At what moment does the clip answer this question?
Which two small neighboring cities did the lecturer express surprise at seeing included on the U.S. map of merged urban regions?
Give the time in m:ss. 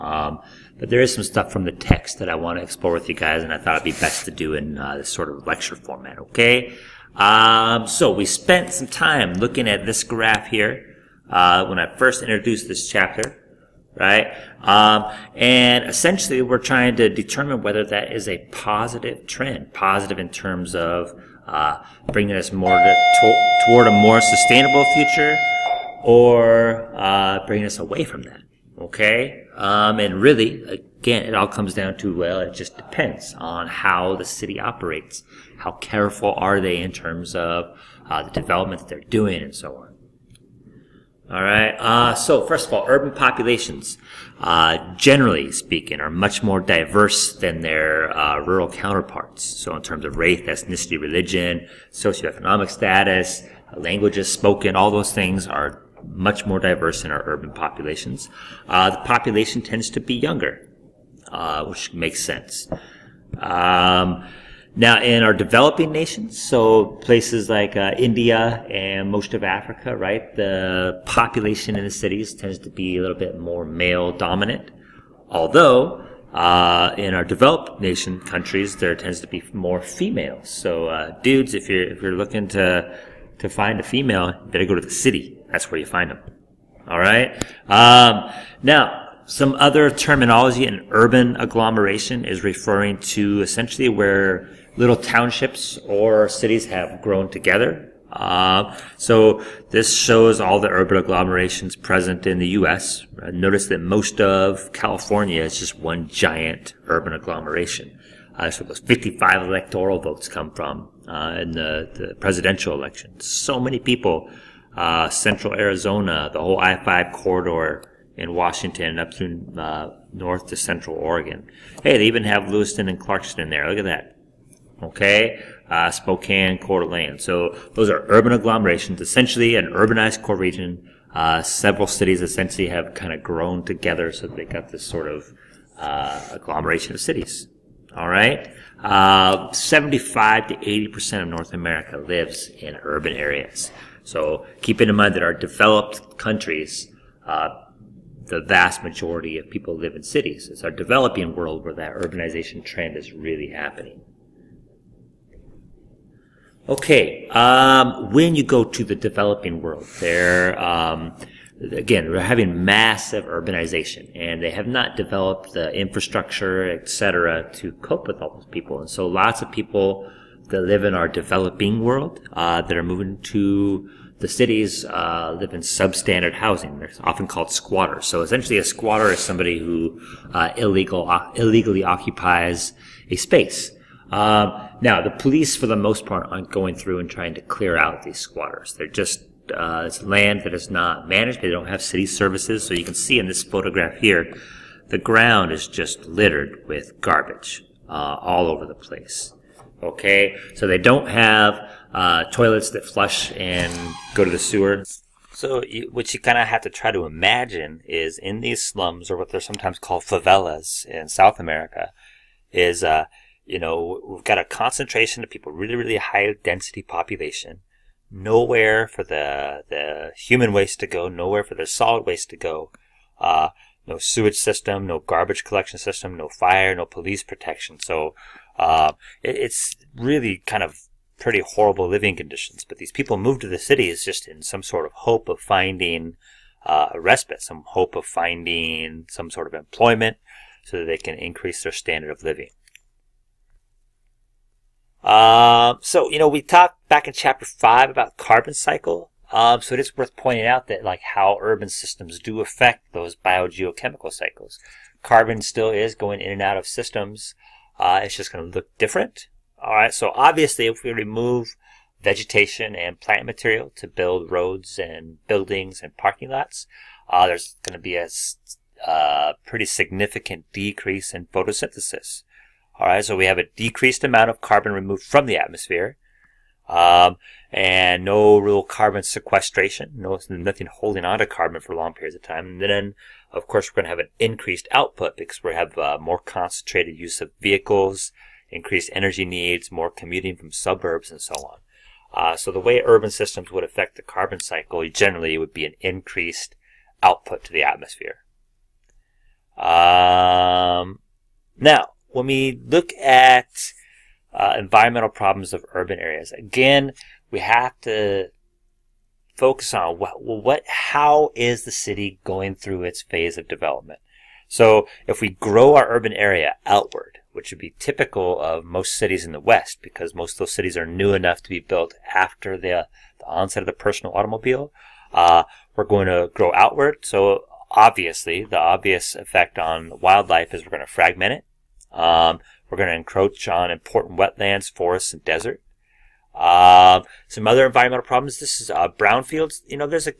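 2:02.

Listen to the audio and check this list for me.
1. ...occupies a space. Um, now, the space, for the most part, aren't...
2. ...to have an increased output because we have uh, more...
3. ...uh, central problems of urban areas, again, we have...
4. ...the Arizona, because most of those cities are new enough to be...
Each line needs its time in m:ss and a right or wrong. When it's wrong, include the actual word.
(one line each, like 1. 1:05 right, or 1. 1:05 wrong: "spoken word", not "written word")
1. 3:01 wrong: "police", not "space"
2. 4:43 right
3. 5:04 wrong: "environmental", not "central"
4. 5:19 wrong: "West", not "Arizona".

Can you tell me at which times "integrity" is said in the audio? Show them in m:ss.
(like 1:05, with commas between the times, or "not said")
not said.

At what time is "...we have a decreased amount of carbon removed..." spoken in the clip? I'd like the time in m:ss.
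4:33.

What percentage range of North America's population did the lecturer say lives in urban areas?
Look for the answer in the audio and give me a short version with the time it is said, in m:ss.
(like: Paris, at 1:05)
75 to 80 percent, at 2:19.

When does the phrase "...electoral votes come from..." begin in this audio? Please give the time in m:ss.
1:49.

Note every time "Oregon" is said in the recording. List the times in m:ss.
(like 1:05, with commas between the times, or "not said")
2:00.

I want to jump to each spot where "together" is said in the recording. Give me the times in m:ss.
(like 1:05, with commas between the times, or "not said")
1:37, 2:13.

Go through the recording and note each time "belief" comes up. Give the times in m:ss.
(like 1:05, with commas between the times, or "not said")
not said.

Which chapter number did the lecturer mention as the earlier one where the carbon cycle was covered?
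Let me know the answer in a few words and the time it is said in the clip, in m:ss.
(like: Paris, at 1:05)
5, at 4:07.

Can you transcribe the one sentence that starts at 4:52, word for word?
Uh, so the way urban systems would affect the carbon cycle generally would be an increased output to the atmosphere.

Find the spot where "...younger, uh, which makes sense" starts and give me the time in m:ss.
1:00.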